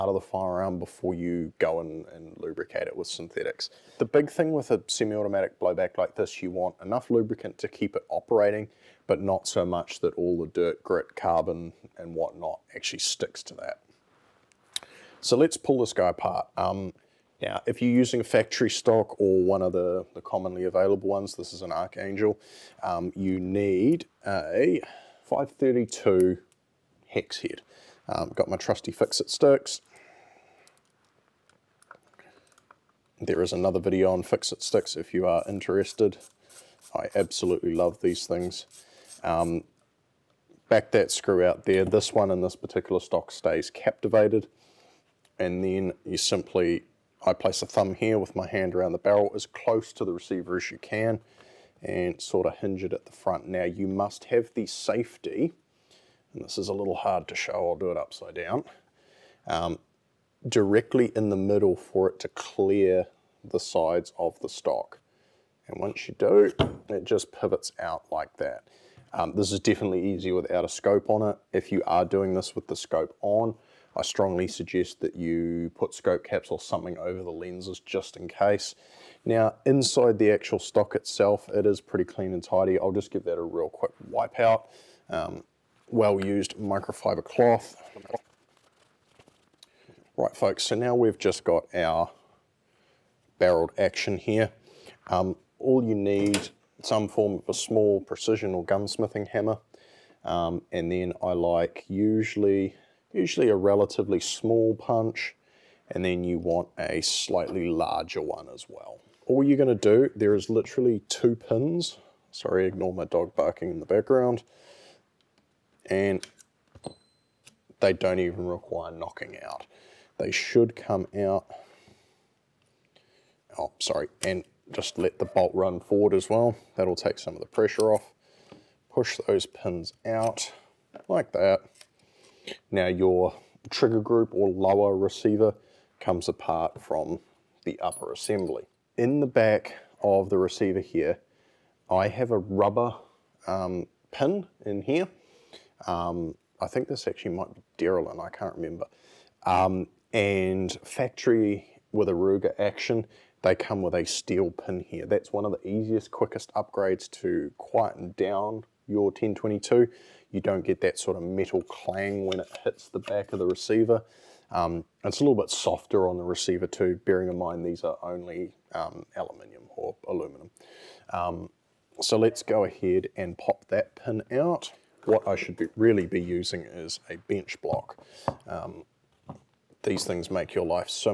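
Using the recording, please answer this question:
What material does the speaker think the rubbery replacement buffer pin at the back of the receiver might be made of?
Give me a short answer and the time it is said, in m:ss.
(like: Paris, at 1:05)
Delrin, at 2:27.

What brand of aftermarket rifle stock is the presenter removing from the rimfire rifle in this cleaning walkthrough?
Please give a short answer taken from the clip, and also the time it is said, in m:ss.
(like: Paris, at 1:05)
Archangel, at 0:21.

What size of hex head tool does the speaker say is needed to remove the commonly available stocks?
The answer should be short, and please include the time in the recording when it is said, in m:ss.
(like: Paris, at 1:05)
5/32, at 0:25.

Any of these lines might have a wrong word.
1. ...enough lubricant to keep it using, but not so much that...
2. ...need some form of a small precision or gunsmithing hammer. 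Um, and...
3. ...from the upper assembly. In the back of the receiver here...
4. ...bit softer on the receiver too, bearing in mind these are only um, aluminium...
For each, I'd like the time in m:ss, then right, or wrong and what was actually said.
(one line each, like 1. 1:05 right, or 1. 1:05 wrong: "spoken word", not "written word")
1. 0:06 wrong: "operating", not "using"
2. 1:35 right
3. 2:16 right
4. 2:45 right.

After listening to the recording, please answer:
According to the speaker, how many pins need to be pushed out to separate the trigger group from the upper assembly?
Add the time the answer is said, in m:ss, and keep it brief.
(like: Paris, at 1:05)
2, at 1:51.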